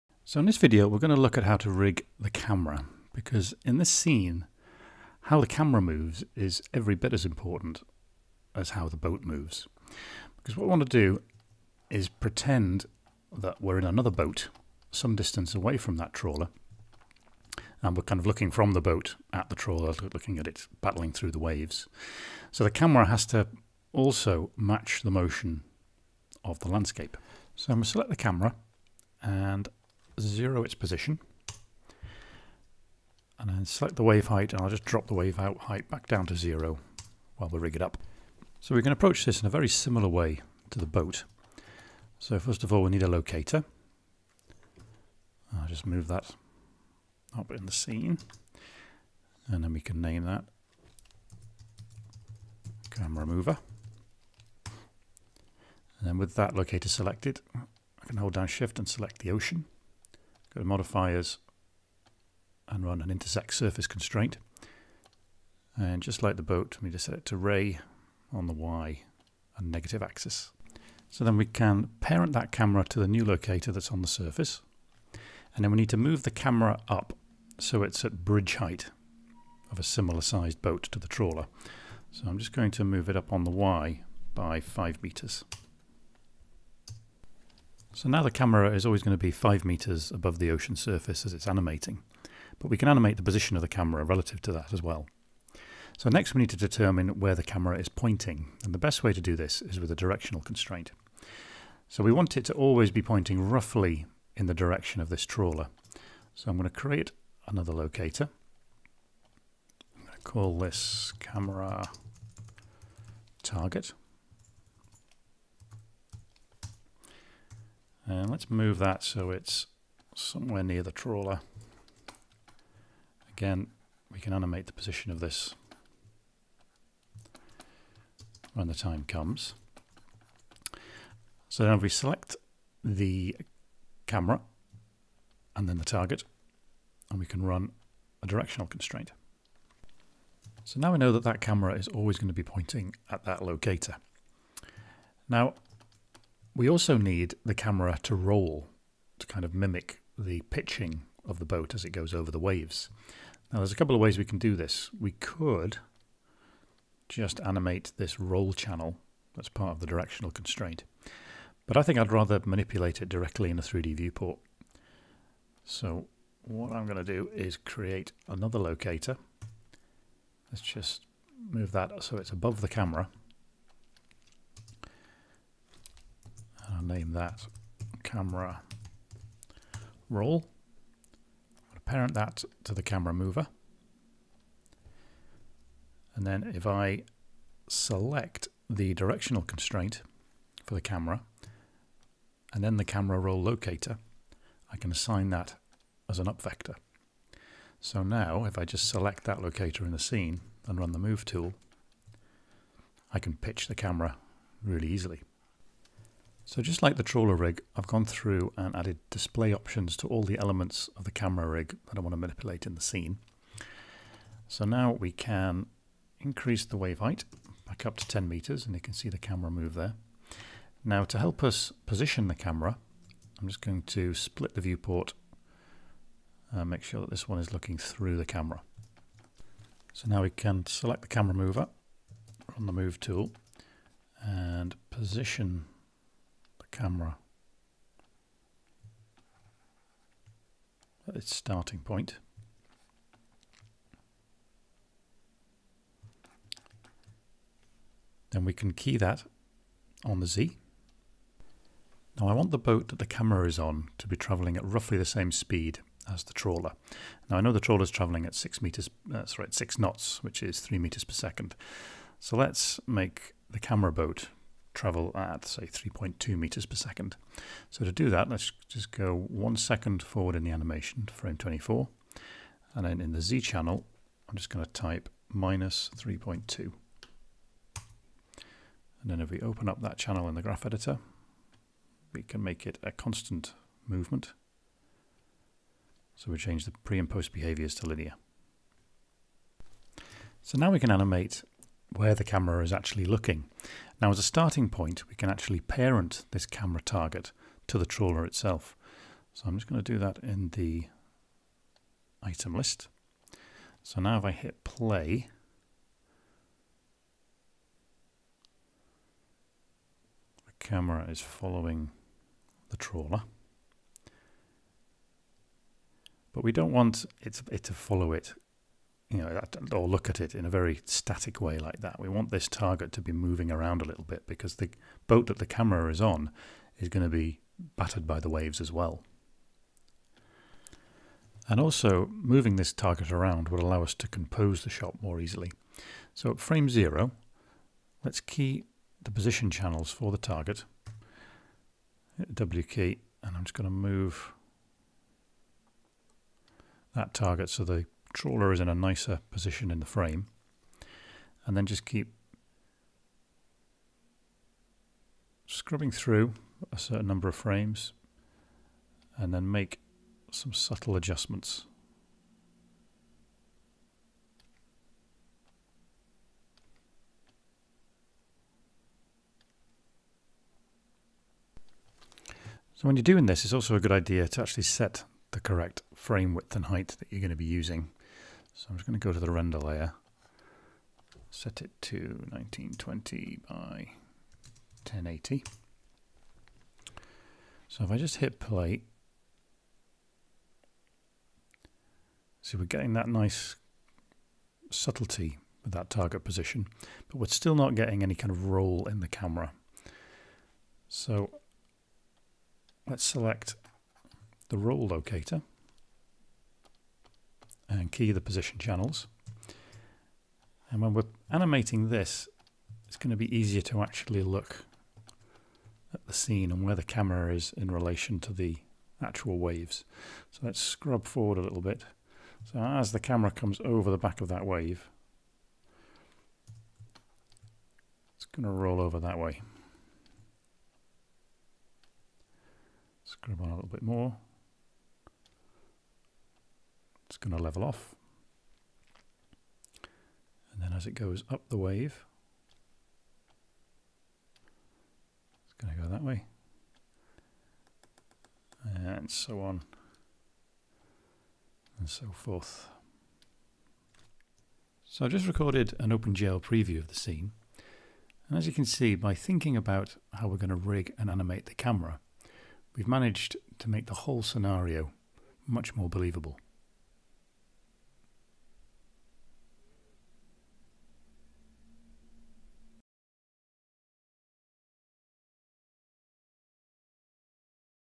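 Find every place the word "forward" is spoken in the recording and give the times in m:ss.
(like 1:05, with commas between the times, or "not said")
4:30, 7:01.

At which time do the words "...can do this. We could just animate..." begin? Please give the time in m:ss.
2:34.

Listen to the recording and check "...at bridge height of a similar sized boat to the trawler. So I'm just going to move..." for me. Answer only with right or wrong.
right.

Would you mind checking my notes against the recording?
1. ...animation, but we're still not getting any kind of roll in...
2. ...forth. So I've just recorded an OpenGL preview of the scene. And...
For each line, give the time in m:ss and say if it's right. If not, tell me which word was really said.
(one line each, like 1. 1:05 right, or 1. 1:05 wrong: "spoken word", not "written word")
1. 6:36 wrong: "position", not "animation"
2. 7:32 right.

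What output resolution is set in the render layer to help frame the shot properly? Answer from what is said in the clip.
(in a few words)
1920 by 1080.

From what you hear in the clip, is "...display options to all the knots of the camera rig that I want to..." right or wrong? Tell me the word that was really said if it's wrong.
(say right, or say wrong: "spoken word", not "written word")
wrong: "elements", not "knots".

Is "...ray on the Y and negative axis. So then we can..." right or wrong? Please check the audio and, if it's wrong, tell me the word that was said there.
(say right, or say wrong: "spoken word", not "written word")
right.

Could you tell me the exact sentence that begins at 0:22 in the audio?
So the camera has to also match the motion of the landscape.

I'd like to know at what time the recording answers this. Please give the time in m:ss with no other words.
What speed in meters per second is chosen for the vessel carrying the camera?
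4:25.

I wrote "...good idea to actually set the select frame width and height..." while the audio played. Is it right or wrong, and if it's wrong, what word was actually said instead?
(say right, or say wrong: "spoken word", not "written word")
wrong: "correct", not "select".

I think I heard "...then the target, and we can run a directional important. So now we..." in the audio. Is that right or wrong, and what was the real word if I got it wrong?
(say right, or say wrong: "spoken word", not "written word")
wrong: "constraint", not "important".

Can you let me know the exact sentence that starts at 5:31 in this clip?
And also, moving this target around will allow us to compose the shot more easily.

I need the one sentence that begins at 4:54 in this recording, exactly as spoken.
Now as a starting point we can actually parent this camera target to the trawler itself.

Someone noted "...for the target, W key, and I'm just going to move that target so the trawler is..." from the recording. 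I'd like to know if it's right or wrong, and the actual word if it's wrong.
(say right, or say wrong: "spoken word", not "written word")
right.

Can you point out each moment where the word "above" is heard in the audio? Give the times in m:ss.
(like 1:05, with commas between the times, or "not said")
1:30, 2:52.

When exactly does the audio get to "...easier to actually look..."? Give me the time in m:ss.
6:53.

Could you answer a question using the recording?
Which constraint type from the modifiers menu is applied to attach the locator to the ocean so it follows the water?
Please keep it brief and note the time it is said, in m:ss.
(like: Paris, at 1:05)
Intersect surface constraint, at 1:03.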